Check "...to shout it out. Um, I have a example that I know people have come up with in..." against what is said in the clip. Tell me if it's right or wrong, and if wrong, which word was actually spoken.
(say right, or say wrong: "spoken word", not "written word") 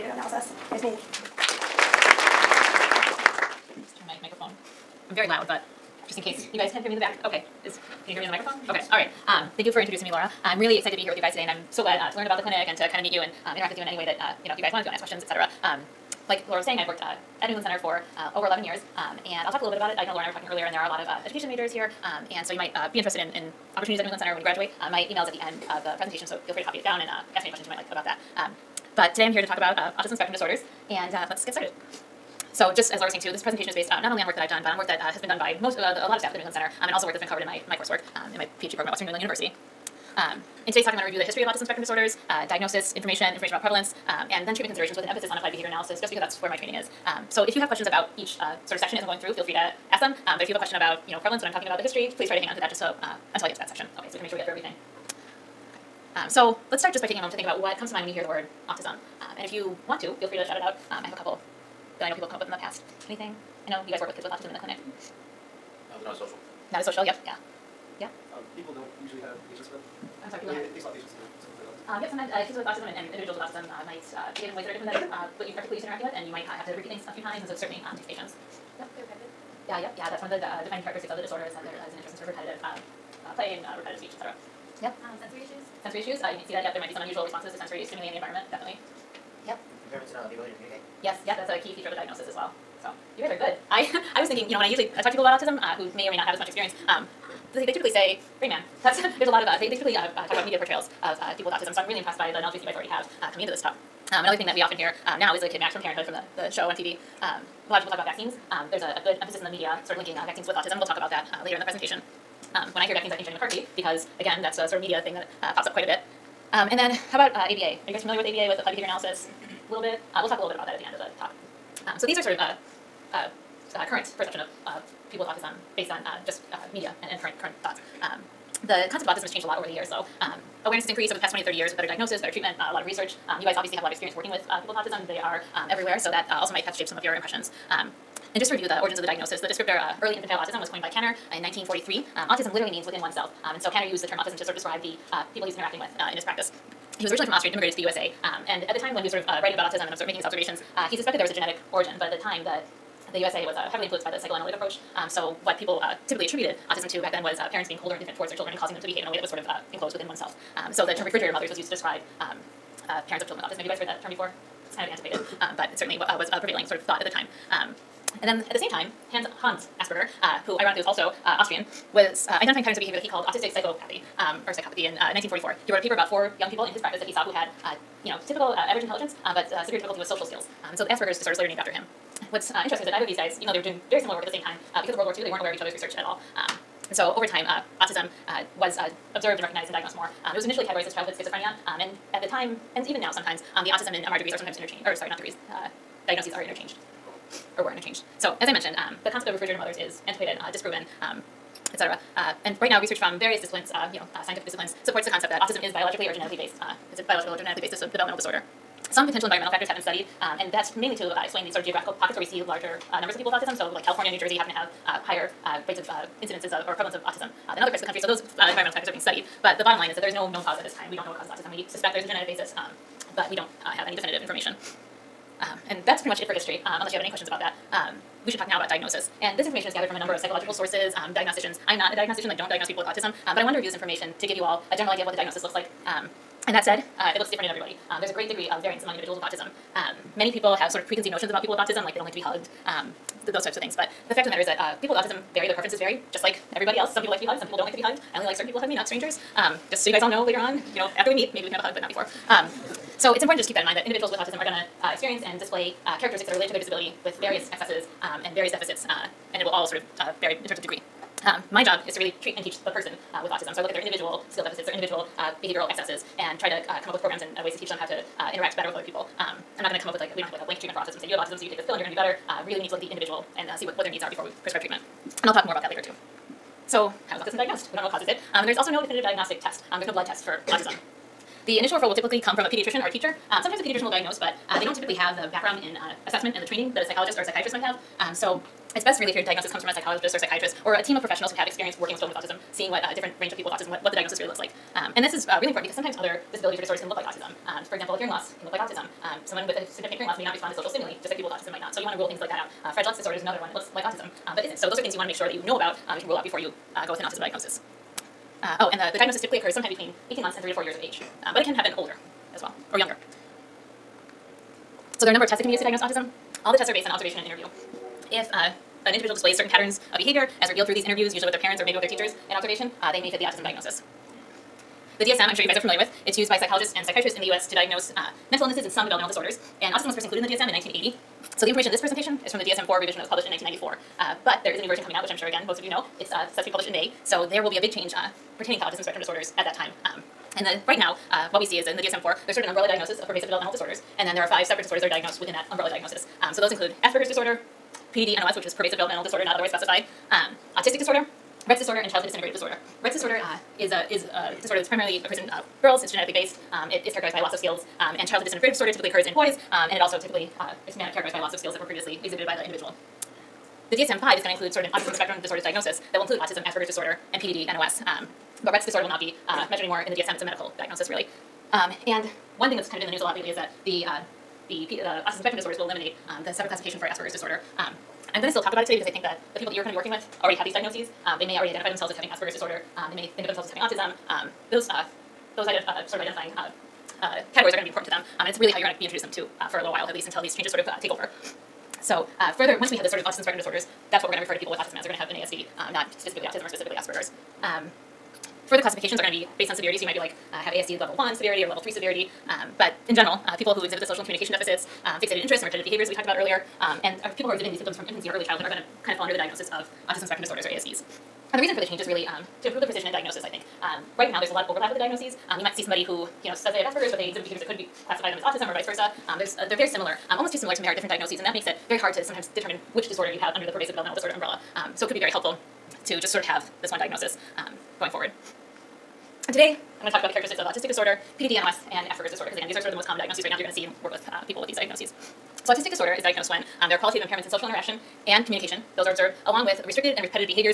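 wrong: "couple", not "example".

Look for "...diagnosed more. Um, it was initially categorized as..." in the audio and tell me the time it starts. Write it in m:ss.
3:09.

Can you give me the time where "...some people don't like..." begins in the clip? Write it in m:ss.
4:07.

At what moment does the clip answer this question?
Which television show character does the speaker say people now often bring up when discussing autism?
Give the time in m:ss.
1:45.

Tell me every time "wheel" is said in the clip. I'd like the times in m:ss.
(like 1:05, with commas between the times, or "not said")
not said.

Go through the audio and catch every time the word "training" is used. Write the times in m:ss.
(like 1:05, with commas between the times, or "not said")
0:46, 4:46.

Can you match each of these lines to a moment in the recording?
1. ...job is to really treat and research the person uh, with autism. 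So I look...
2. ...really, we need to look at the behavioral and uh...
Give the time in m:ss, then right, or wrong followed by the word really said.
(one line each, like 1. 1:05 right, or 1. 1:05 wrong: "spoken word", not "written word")
1. 4:21 wrong: "teach", not "research"
2. 4:32 wrong: "individual", not "behavioral".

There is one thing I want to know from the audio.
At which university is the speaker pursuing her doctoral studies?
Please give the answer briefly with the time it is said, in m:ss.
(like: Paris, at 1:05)
Western New England University, at 0:38.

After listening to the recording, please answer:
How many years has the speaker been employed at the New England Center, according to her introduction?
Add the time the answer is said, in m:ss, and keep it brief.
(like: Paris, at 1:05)
Over 11 years, at 0:18.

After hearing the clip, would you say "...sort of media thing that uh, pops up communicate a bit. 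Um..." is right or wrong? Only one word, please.
wrong.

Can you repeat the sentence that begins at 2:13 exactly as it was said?
Um, you guys obviously have a lot of experience working with uh, people with autism.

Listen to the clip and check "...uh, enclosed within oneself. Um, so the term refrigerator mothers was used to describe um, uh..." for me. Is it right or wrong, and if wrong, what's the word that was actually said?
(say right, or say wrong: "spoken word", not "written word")
right.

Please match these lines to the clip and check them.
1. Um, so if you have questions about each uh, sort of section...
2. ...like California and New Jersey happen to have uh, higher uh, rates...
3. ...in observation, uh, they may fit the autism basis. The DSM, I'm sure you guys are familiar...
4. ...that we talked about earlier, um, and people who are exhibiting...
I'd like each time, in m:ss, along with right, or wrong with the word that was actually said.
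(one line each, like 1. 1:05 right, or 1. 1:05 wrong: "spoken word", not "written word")
1. 0:47 right
2. 3:33 right
3. 5:22 wrong: "diagnosis", not "basis"
4. 6:45 right.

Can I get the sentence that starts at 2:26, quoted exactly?
He was originally from Austria and immigrated to the USA.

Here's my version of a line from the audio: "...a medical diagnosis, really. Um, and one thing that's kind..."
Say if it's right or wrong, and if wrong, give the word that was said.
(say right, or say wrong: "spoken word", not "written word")
right.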